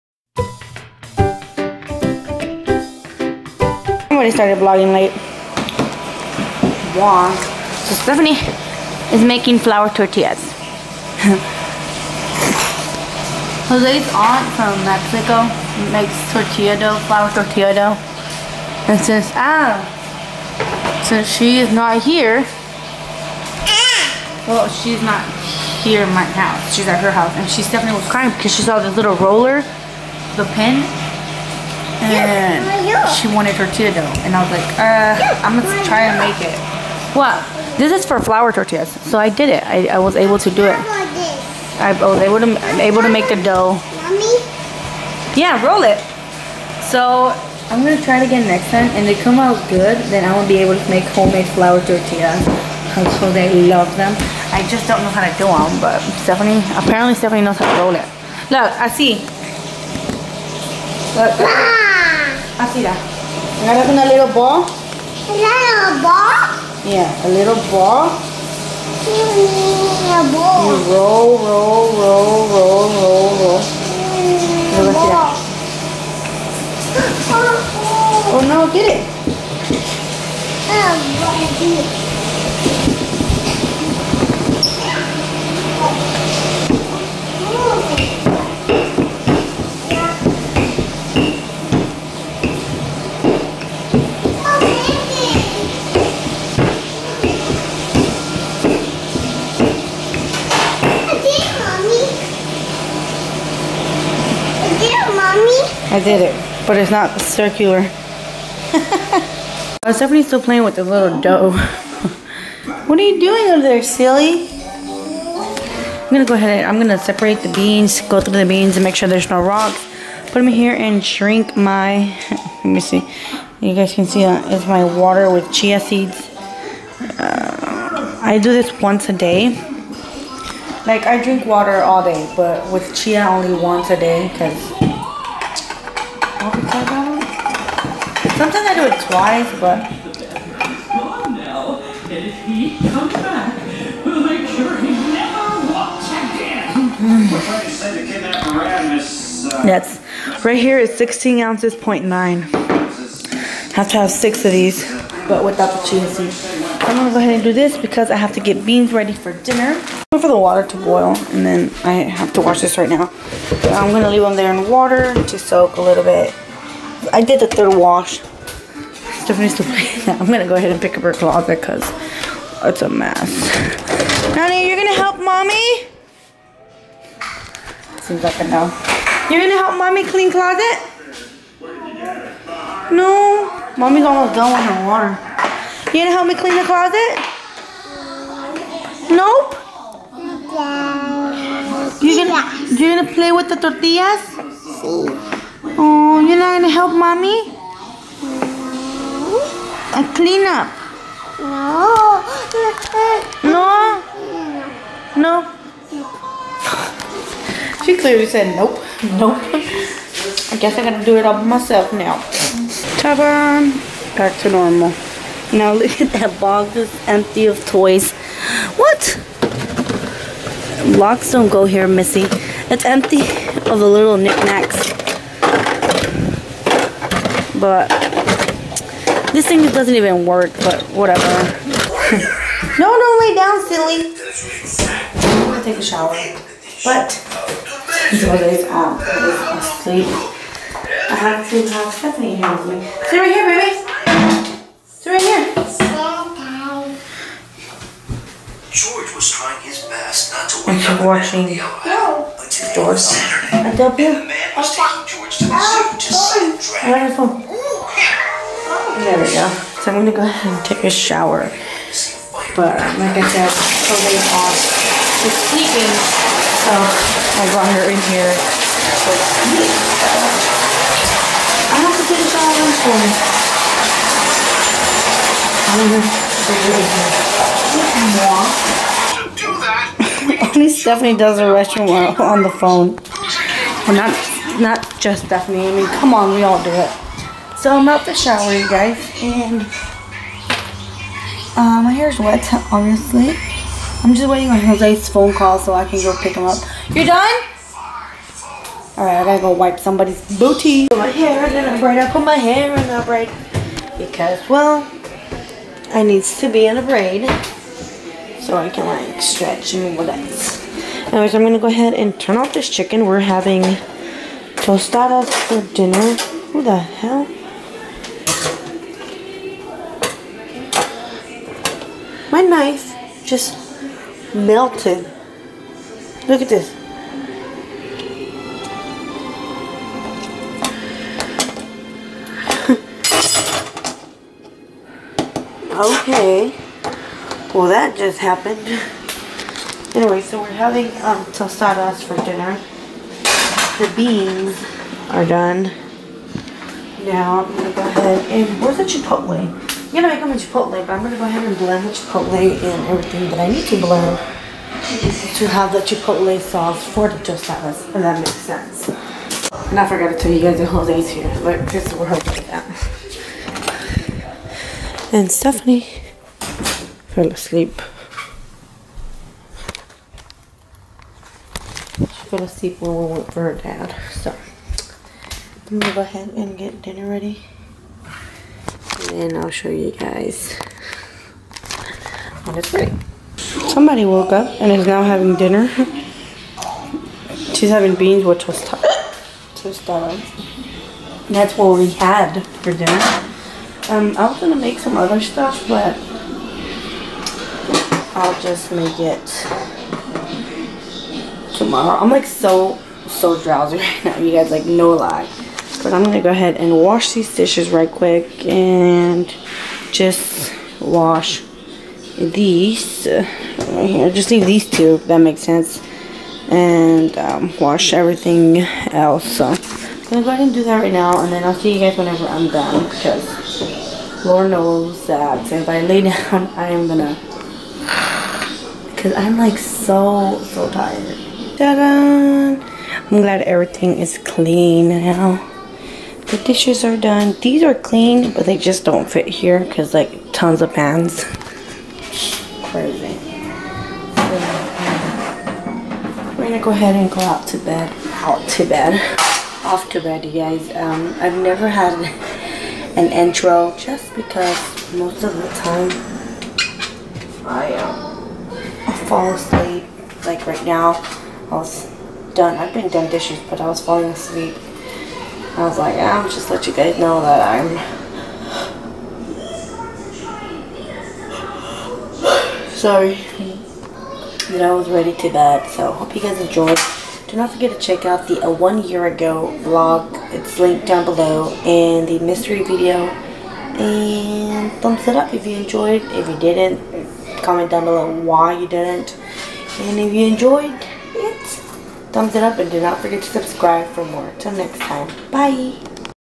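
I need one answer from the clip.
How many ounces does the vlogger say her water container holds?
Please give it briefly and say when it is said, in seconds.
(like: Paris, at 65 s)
16, at 150 s.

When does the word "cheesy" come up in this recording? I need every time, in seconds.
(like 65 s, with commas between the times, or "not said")
155 s.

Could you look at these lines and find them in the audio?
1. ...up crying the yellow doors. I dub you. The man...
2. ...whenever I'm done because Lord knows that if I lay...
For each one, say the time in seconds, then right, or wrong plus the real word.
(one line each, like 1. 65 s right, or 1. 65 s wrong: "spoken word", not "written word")
1. 250 s wrong: "watching", not "crying"
2. 421 s right.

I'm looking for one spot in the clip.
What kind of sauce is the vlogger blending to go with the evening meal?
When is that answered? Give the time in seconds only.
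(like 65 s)
355 s.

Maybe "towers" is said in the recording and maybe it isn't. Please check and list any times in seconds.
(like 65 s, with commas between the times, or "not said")
not said.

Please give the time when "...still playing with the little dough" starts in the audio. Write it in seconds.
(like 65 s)
110 s.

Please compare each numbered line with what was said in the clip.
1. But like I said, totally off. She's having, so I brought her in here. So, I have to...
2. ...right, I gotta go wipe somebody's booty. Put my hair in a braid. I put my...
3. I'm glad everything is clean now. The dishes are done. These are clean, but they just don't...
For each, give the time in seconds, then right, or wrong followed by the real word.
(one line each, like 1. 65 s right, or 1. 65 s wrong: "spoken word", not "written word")
1. 262 s wrong: "sleeping", not "having"
2. 299 s right
3. 432 s right.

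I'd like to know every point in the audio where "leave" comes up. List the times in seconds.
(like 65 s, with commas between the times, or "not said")
164 s, 414 s.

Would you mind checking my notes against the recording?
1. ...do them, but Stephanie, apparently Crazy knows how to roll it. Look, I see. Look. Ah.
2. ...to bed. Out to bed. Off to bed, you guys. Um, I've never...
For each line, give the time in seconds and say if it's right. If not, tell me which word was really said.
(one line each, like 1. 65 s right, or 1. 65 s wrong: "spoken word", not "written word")
1. 55 s wrong: "Stephanie", not "Crazy"
2. 447 s right.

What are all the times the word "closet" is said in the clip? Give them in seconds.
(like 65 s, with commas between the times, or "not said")
171 s, 180 s, 186 s.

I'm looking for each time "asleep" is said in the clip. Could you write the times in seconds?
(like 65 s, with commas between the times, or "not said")
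240 s, 367 s, 372 s, 459 s, 464 s.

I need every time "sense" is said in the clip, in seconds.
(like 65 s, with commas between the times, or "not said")
358 s, 415 s.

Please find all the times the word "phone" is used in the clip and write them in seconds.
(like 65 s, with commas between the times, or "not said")
282 s, 295 s.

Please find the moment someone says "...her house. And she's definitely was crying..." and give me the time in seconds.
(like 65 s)
27 s.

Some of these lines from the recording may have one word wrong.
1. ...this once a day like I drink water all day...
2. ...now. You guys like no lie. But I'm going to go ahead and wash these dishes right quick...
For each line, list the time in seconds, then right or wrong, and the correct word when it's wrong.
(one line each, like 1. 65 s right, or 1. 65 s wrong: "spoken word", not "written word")
1. 128 s right
2. 404 s right.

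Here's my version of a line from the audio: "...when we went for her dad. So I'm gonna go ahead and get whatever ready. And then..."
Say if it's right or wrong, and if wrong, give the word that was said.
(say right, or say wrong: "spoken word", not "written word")
wrong: "dinner", not "whatever".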